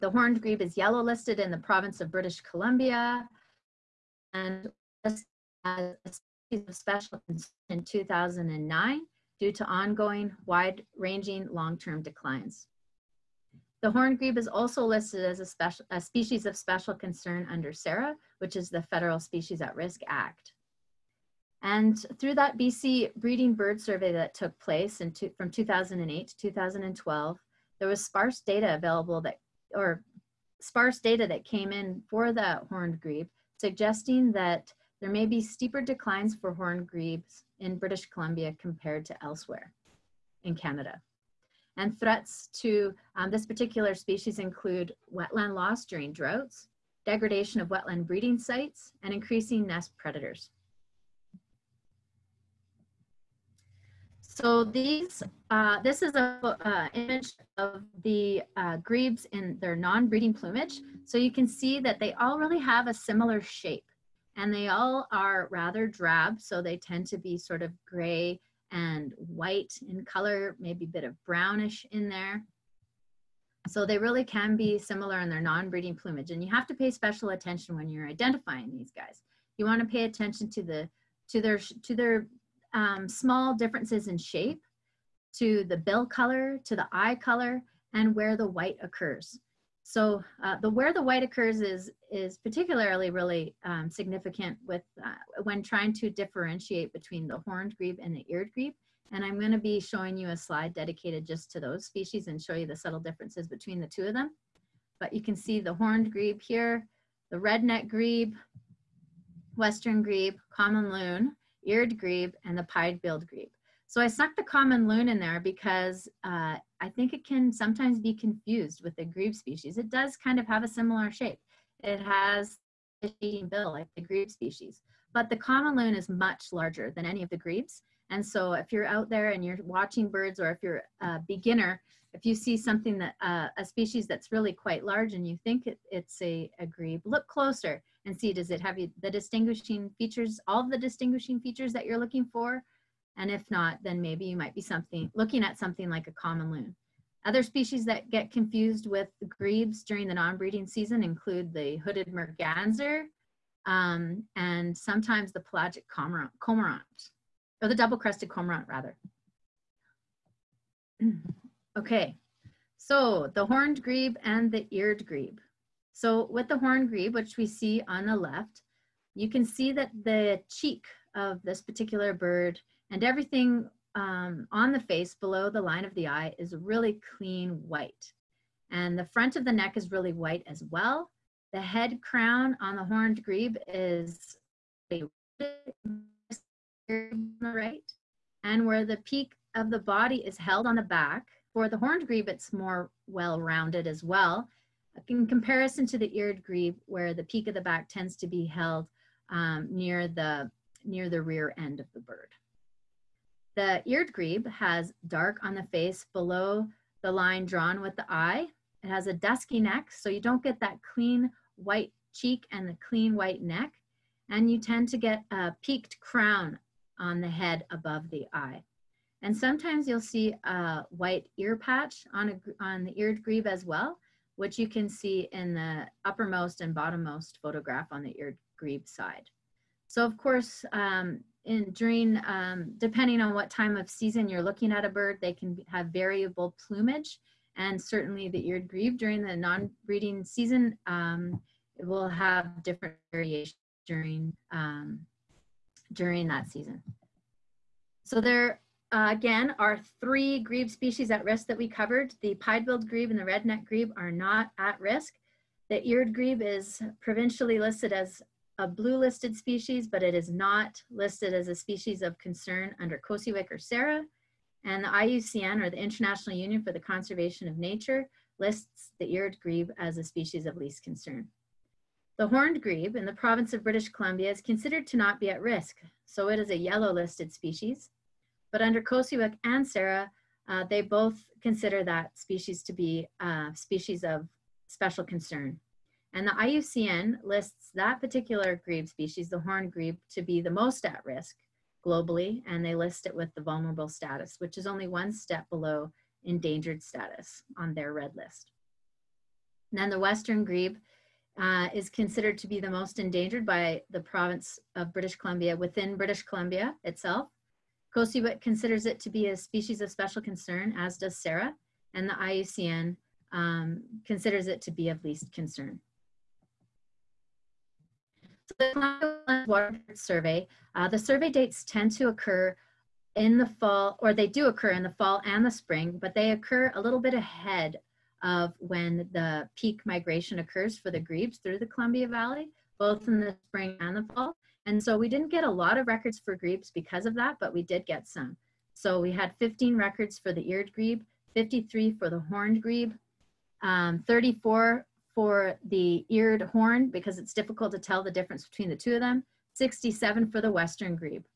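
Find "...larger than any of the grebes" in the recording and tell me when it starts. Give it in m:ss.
2:06.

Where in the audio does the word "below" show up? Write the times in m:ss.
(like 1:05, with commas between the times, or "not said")
2:55, 3:26, 4:55.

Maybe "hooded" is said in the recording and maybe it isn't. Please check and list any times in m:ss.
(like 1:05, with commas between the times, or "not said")
2:31.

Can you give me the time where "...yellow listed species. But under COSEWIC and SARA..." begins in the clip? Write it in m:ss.
4:36.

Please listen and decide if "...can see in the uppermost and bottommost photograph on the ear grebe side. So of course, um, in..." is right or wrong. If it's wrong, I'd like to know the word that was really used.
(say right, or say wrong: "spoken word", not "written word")
right.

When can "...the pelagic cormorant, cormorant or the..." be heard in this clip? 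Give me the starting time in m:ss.
2:35.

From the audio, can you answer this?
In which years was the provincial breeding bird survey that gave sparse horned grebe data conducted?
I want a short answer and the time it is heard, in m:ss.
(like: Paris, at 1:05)
2008 to 2012, at 0:25.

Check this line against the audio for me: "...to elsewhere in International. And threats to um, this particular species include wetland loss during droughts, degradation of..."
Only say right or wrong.
wrong.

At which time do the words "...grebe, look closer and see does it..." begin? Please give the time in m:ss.
2:16.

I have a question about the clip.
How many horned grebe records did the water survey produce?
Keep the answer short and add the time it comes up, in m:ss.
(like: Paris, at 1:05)
53, at 5:41.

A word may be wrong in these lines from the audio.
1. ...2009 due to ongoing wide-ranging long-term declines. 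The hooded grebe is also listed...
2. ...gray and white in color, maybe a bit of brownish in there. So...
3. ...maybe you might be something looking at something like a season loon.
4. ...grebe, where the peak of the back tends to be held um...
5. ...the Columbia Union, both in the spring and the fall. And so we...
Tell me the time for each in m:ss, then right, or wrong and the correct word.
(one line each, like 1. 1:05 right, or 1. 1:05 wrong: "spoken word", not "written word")
1. 0:07 wrong: "horned", not "hooded"
2. 1:07 right
3. 2:23 wrong: "common", not "season"
4. 3:16 right
5. 5:31 wrong: "Valley", not "Union".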